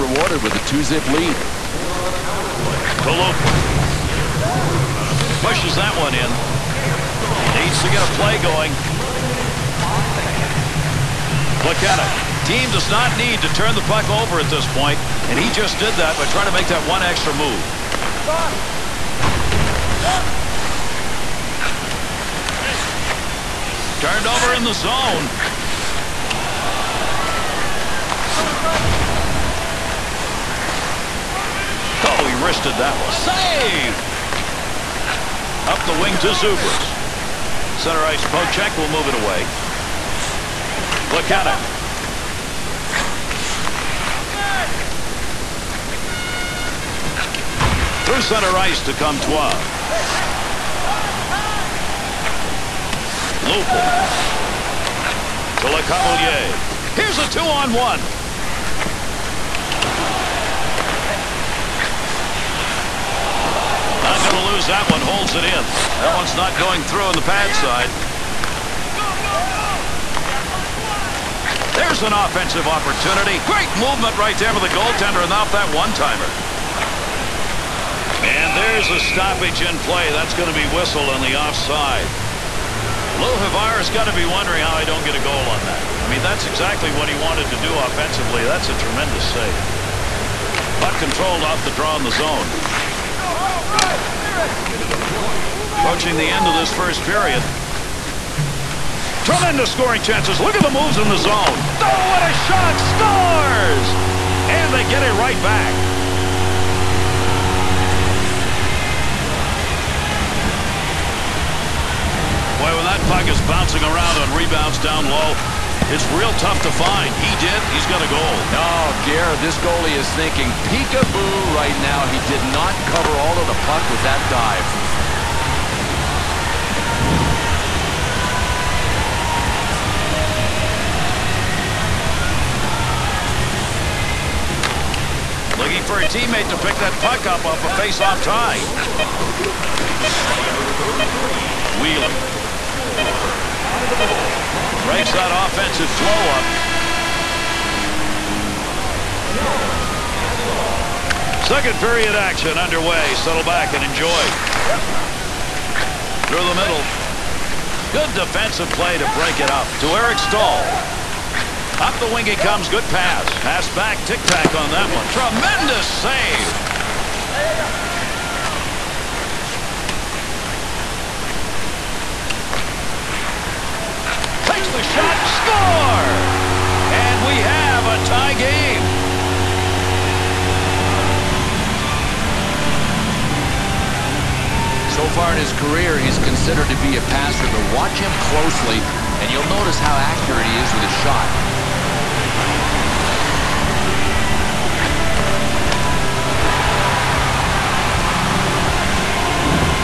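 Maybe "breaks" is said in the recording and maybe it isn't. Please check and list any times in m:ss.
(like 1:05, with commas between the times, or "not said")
2:24, 2:39.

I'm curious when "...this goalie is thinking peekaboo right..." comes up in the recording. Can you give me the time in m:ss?
1:59.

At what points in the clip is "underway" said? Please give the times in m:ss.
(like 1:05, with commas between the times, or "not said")
2:32.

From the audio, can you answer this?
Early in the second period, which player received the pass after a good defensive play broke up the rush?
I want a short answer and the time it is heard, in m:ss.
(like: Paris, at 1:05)
Eric Staal, at 2:39.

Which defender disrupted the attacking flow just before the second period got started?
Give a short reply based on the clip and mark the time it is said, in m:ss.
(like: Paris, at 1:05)
Wheeler, at 2:21.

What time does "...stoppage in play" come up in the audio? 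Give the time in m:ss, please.
1:18.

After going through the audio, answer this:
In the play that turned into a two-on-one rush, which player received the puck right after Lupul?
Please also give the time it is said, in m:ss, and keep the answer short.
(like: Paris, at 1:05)
Le Cavalier, at 0:55.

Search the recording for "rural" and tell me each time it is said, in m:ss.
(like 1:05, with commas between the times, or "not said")
not said.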